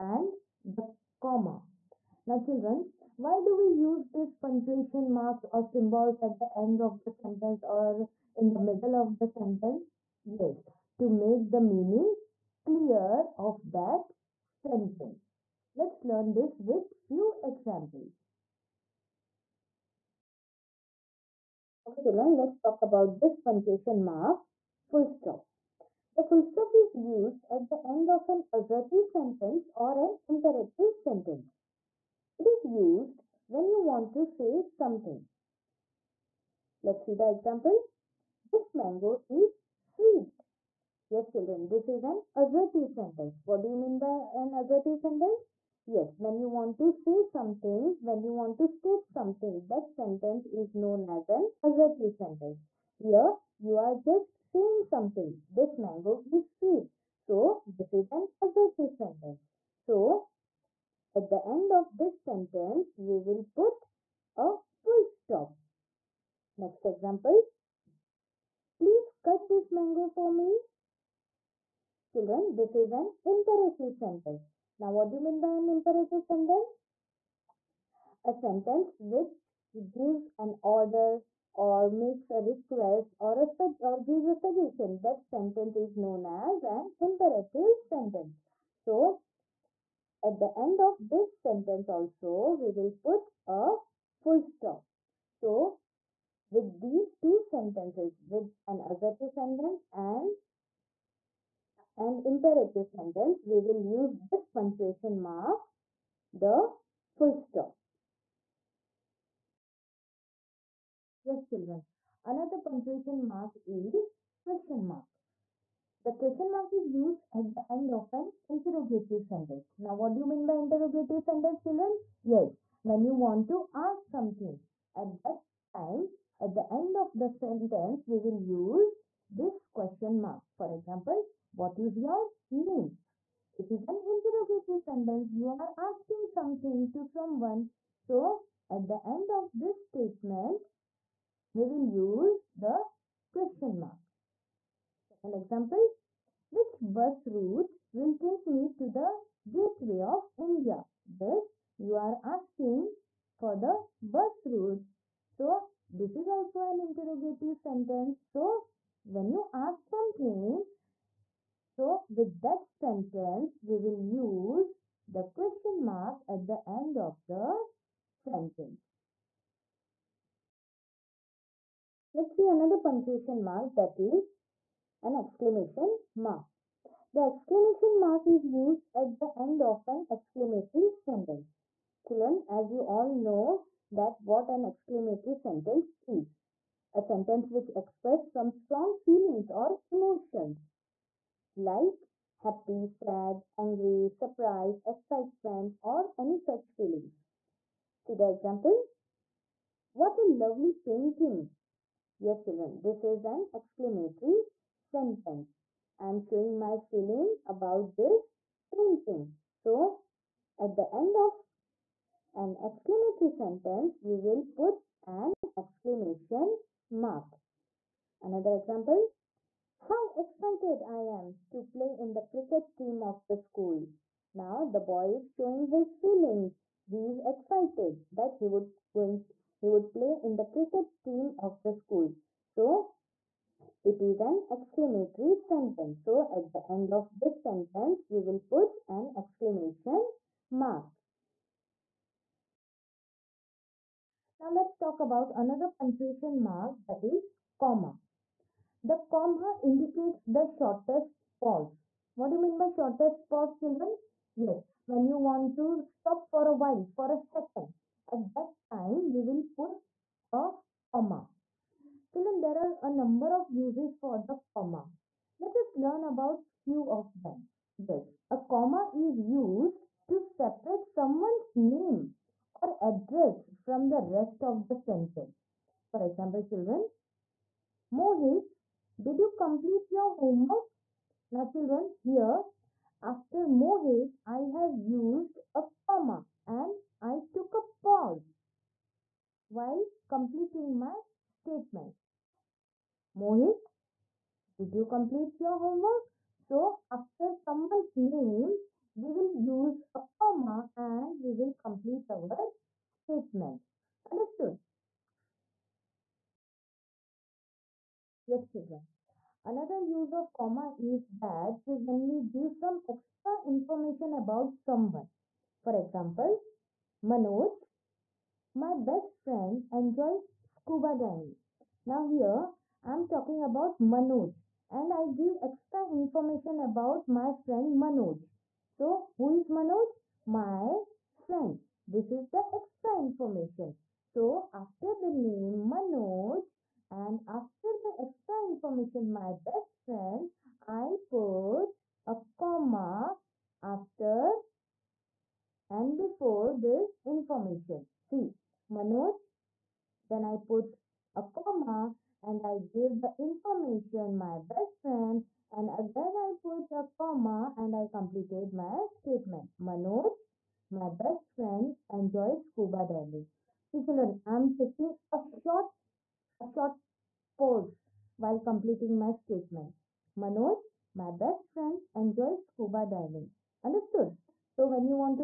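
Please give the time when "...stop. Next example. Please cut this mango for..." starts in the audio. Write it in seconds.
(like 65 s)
65 s.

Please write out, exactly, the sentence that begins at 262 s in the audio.
Children, there are a number of uses for the comma.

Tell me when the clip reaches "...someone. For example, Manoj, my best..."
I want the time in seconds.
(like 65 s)
314 s.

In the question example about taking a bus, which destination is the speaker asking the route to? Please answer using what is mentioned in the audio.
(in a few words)
Gateway of India.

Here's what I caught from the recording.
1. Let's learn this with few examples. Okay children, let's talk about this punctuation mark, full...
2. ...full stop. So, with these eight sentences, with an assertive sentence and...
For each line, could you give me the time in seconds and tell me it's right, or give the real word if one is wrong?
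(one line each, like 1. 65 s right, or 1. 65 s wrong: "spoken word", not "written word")
1. 15 s right
2. 94 s wrong: "two", not "eight".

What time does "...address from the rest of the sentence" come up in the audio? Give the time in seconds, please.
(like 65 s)
272 s.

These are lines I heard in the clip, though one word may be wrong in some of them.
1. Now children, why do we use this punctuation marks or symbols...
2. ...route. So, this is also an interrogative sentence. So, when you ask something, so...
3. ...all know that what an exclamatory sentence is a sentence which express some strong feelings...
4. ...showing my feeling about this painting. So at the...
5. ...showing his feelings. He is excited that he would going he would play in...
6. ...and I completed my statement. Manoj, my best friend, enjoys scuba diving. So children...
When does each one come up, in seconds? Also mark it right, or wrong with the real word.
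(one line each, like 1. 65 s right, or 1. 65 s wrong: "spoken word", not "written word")
1. 2 s right
2. 154 s right
3. 182 s right
4. 206 s right
5. 225 s right
6. 357 s right.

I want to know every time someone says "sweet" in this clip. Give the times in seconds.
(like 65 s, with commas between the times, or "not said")
39 s, 56 s.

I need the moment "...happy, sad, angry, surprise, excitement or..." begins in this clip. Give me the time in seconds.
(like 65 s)
192 s.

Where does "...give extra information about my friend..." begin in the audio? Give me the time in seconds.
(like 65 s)
325 s.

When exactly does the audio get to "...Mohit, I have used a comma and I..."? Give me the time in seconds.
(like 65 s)
283 s.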